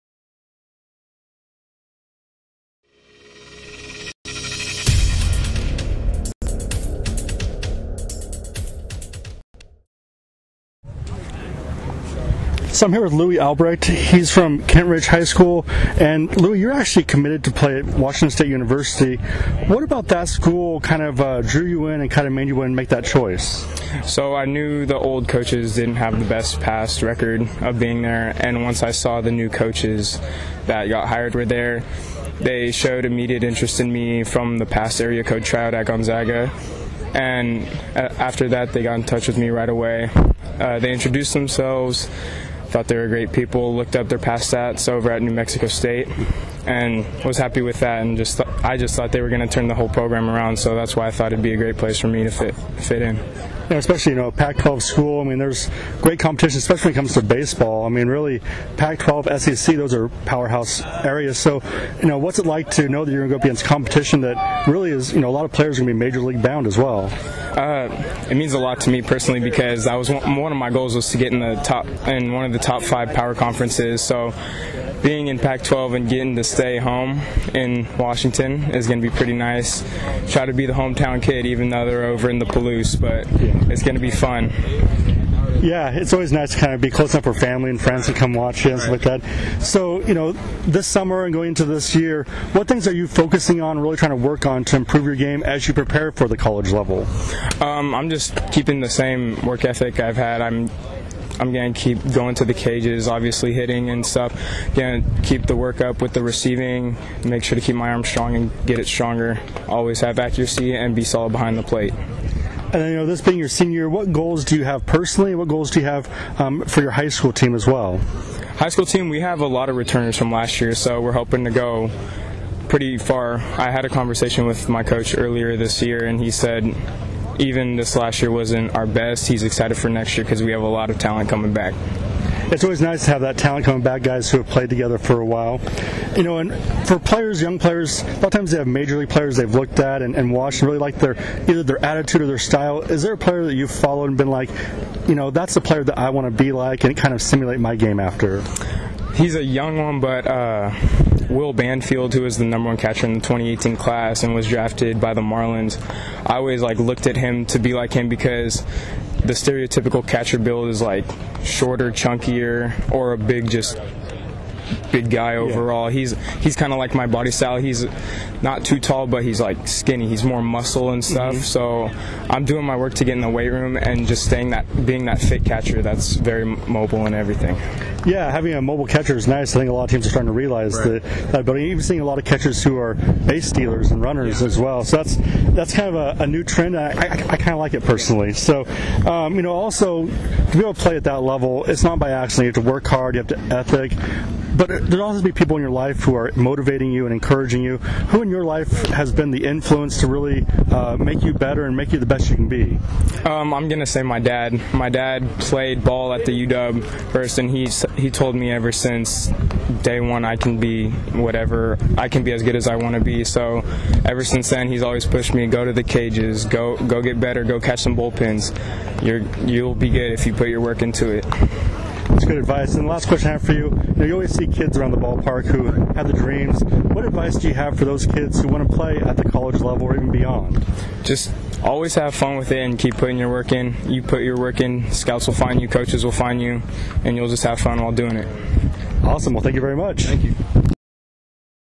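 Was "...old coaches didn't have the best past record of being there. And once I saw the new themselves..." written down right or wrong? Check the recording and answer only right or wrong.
wrong.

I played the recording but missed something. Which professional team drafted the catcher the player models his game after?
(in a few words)
Marlins.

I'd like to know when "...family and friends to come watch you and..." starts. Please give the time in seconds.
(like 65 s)
87 s.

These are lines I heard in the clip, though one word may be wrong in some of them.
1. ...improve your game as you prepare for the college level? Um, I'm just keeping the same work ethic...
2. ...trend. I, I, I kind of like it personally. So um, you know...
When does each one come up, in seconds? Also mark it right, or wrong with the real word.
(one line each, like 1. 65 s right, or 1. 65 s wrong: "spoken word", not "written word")
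1. 94 s right
2. 186 s right.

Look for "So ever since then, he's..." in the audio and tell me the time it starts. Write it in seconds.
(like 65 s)
213 s.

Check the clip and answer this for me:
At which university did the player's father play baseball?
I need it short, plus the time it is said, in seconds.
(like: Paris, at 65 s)
UW, at 206 s.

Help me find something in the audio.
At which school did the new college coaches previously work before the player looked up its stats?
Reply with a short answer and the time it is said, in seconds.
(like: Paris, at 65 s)
New Mexico State, at 45 s.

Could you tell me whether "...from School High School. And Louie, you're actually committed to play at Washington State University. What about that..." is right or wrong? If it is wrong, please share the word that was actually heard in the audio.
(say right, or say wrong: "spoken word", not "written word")
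wrong: "Kentridge", not "School".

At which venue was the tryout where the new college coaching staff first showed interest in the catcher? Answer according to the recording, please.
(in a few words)
Gonzaga.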